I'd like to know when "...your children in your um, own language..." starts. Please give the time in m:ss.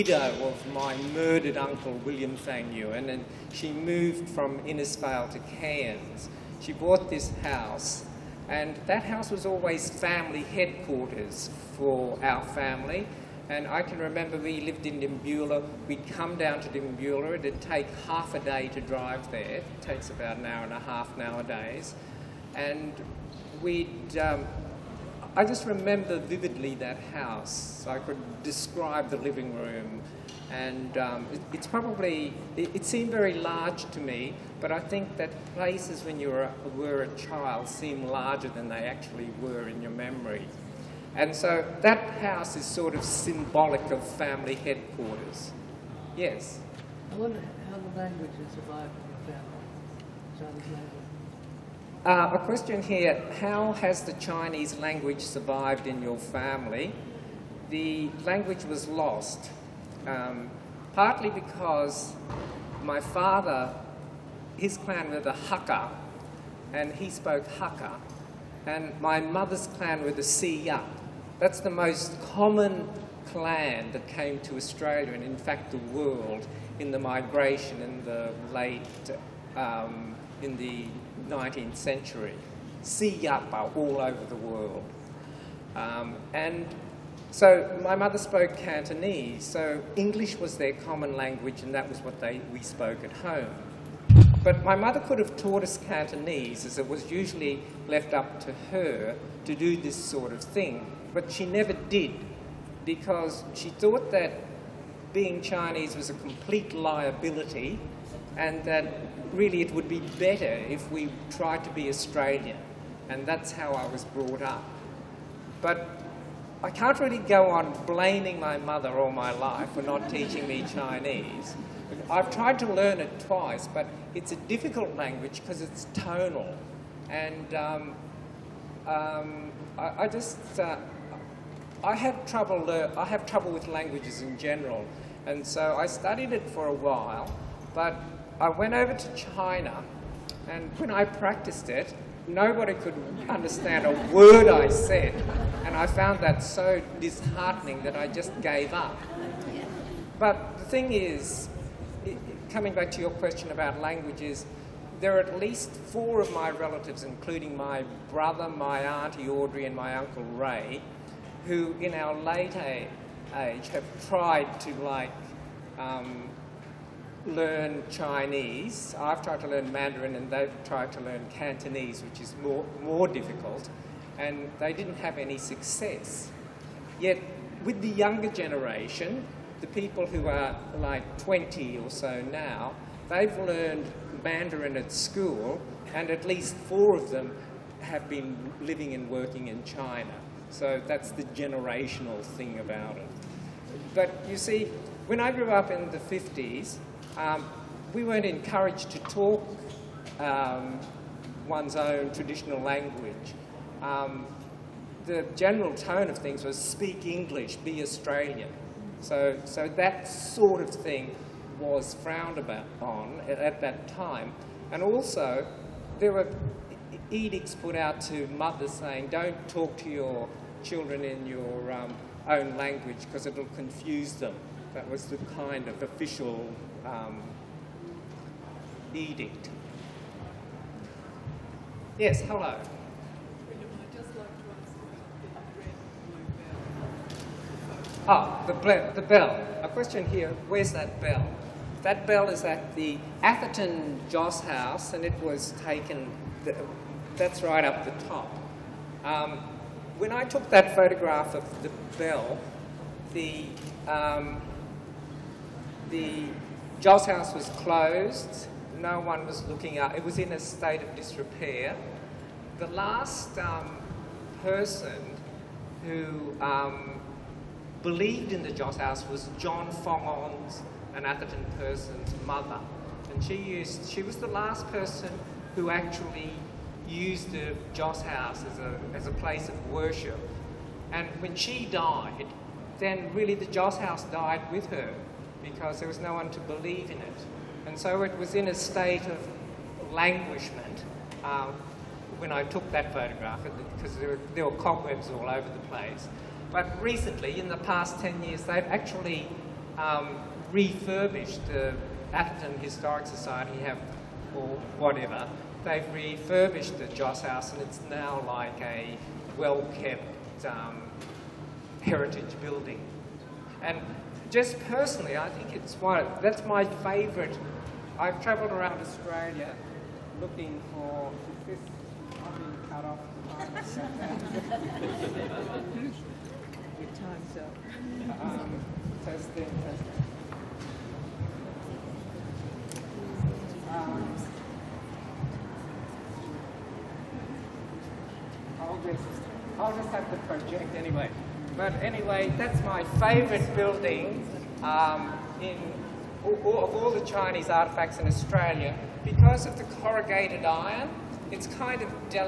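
3:39.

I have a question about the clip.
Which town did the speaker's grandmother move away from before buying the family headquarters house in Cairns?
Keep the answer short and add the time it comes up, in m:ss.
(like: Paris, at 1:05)
Innisfail, at 0:04.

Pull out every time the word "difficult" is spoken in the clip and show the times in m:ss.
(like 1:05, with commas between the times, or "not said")
2:04, 2:53.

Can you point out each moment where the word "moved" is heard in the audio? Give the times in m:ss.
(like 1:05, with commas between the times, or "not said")
0:03.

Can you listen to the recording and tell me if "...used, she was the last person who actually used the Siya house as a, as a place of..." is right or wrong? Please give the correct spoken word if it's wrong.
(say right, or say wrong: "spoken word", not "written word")
wrong: "Joss", not "Siya".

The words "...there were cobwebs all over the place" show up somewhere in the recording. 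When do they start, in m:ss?
4:54.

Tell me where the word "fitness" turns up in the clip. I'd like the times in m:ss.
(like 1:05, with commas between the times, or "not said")
not said.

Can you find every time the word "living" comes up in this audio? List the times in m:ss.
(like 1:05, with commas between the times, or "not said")
0:29, 3:08.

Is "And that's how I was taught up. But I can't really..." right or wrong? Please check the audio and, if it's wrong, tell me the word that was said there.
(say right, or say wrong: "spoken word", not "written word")
wrong: "brought", not "taught".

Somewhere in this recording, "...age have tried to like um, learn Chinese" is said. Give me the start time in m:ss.
2:42.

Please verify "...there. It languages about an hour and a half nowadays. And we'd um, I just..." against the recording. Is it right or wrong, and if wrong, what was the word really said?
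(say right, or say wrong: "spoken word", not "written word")
wrong: "takes", not "languages".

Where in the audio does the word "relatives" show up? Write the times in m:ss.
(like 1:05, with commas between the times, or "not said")
2:36.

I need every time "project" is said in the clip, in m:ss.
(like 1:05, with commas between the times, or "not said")
5:40.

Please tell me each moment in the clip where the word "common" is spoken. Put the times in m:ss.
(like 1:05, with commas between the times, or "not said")
1:12, 1:30.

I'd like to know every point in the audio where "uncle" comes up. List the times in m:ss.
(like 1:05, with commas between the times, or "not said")
0:01, 2:39.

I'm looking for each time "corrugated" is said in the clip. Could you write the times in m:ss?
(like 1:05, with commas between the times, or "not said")
5:49.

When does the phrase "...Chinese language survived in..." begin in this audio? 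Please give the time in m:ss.
0:54.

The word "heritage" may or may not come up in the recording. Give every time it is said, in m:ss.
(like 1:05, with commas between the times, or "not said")
5:11.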